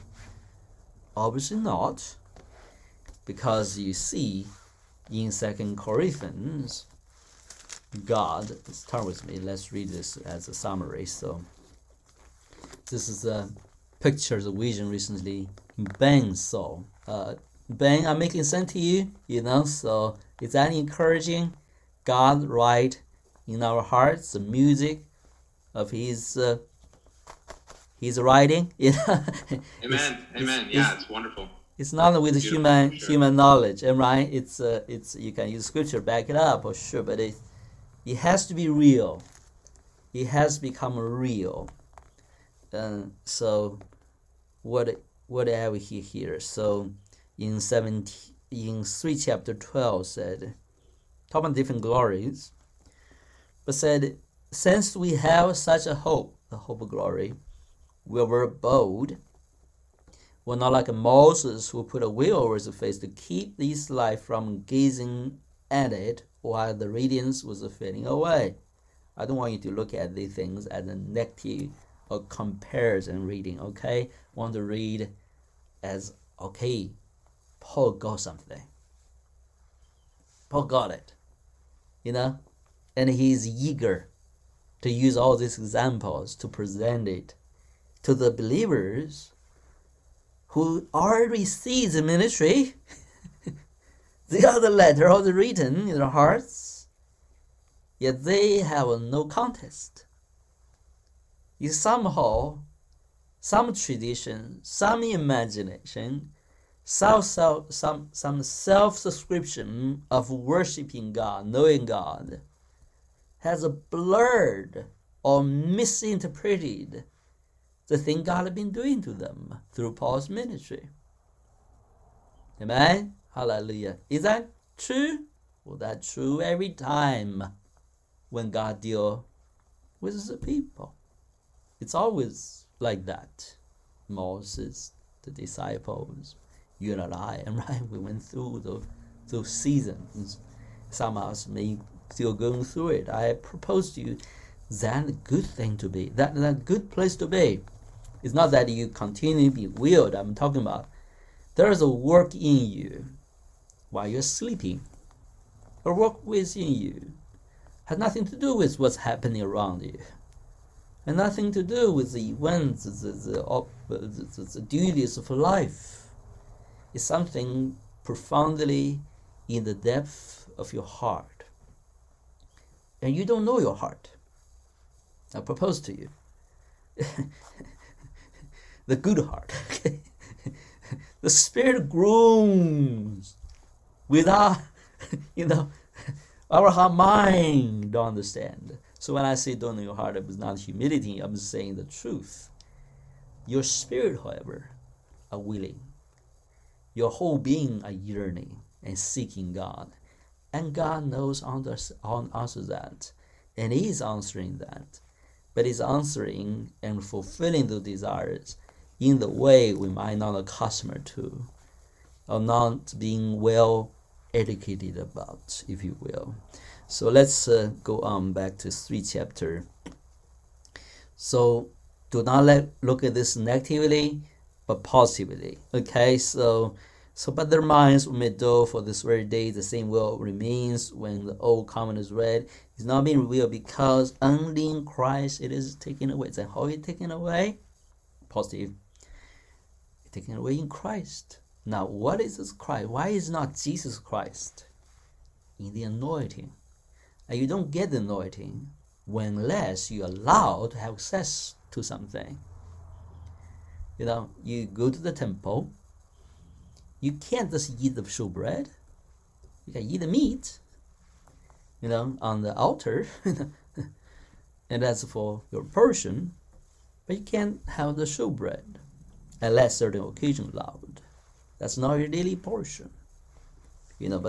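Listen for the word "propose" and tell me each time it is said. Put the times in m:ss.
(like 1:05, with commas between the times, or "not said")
2:23, 2:55.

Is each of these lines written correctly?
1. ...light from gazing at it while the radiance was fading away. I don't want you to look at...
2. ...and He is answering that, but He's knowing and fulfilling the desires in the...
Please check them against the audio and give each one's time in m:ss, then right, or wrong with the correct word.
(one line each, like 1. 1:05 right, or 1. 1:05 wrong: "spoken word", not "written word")
1. 1:03 right
2. 3:23 wrong: "answering", not "knowing".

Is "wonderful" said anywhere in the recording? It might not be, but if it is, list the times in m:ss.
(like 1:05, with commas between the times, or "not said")
0:31.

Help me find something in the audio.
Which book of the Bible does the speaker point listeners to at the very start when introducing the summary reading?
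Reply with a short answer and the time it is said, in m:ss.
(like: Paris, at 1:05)
Second Corinthians, at 0:05.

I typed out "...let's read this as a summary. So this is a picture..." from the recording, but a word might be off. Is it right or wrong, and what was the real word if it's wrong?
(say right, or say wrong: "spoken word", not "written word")
right.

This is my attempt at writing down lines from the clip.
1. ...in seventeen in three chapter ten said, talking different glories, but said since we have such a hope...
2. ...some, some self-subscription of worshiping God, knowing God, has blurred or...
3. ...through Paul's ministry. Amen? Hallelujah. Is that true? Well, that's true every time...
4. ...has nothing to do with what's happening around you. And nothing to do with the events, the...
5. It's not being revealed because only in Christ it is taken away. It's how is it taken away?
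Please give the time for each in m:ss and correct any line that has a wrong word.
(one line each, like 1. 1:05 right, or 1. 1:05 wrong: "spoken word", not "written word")
1. 0:47 wrong: "twelve", not "ten"
2. 1:47 right
3. 1:59 right
4. 2:37 right
5. 3:52 right.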